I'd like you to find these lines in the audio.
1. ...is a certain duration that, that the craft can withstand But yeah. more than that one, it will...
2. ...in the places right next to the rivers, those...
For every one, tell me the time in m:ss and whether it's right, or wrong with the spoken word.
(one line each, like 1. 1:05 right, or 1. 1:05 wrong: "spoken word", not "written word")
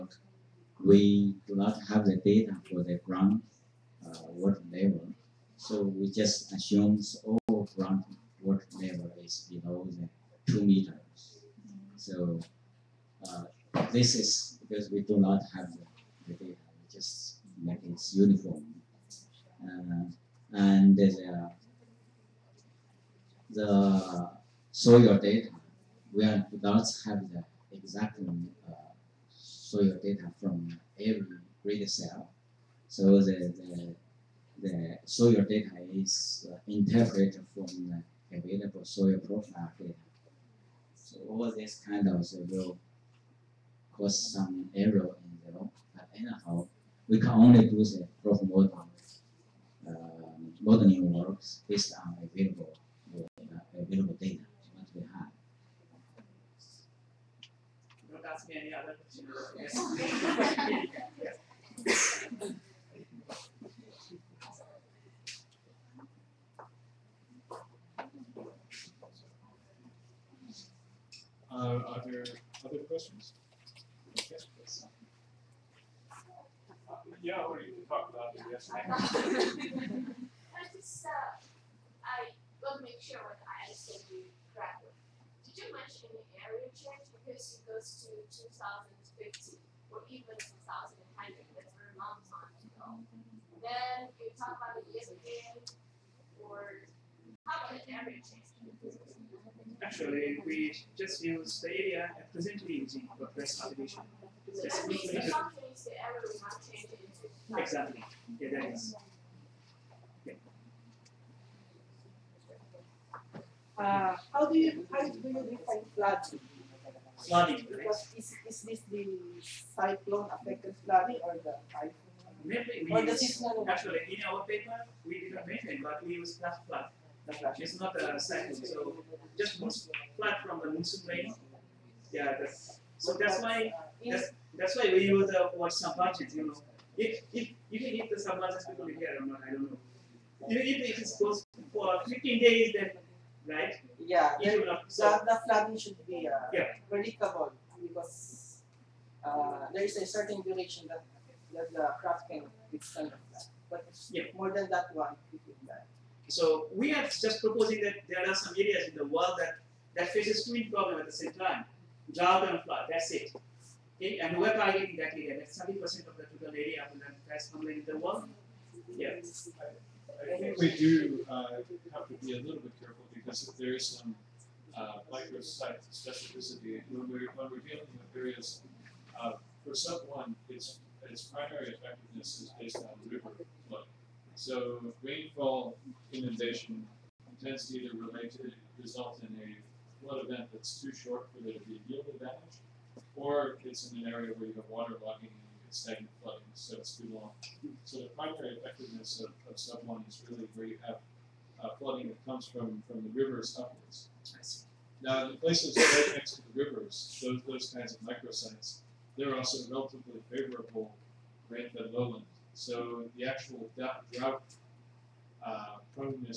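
1. 2:29 right
2. 3:25 right.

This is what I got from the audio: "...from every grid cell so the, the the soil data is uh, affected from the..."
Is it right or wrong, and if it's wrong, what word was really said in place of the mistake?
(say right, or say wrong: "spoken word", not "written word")
wrong: "interpreted", not "affected".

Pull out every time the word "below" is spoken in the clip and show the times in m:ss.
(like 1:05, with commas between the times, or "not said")
0:09.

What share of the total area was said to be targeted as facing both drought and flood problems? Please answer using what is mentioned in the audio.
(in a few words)
70 percent.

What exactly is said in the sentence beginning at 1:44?
So that means the companies, the area will not change Exactly.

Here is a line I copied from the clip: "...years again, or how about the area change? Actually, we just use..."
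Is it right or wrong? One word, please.
right.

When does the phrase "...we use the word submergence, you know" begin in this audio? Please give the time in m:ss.
2:14.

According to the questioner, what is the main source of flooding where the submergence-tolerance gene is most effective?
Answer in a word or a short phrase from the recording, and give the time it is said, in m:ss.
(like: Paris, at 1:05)
River flow, at 3:03.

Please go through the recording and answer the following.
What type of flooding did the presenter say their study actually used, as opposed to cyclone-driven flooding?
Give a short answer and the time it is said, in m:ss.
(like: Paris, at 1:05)
Flash flood, at 2:06.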